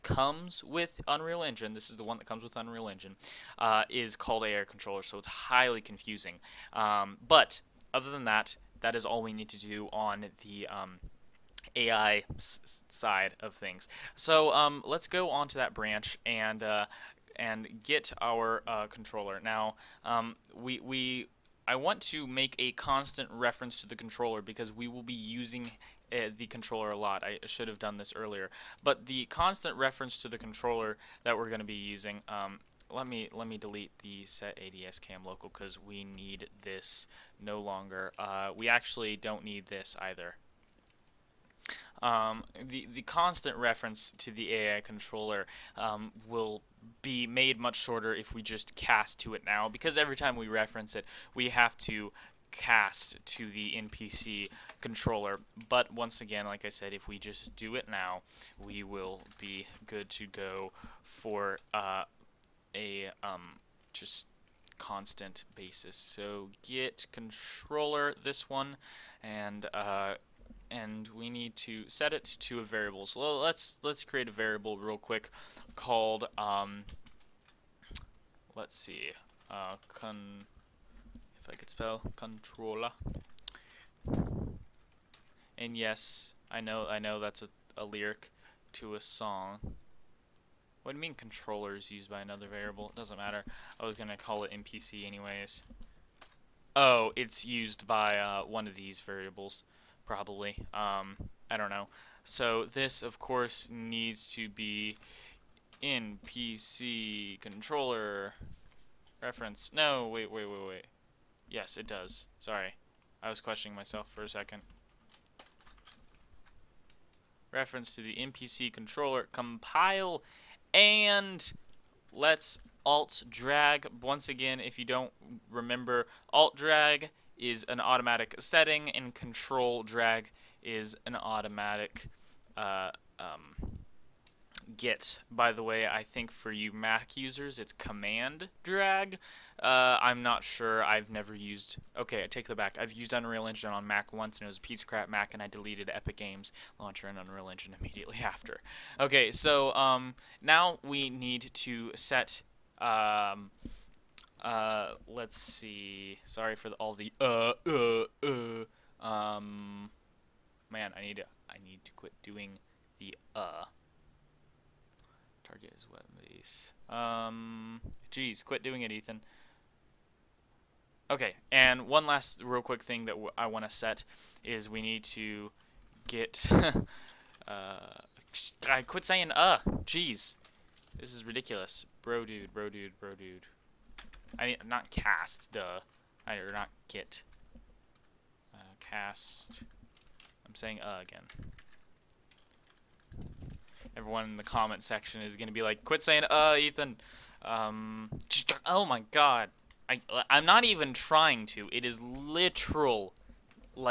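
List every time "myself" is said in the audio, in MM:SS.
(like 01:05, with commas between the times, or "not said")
01:53.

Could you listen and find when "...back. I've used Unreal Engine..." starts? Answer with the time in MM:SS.
02:22.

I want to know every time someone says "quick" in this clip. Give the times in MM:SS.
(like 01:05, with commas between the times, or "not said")
01:14, 02:52.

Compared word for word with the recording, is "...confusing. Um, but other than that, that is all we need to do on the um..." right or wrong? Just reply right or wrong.
right.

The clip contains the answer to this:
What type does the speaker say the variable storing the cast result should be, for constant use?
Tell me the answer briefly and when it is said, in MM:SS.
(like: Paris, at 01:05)
NPC controller reference, at 01:45.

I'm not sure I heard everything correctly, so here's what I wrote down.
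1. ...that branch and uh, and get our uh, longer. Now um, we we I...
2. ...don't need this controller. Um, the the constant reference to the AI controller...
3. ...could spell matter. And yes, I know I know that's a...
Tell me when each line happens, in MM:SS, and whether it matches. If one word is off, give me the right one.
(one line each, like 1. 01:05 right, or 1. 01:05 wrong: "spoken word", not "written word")
1. 00:15 wrong: "controller", not "longer"
2. 00:39 wrong: "either", not "controller"
3. 01:21 wrong: "controller", not "matter".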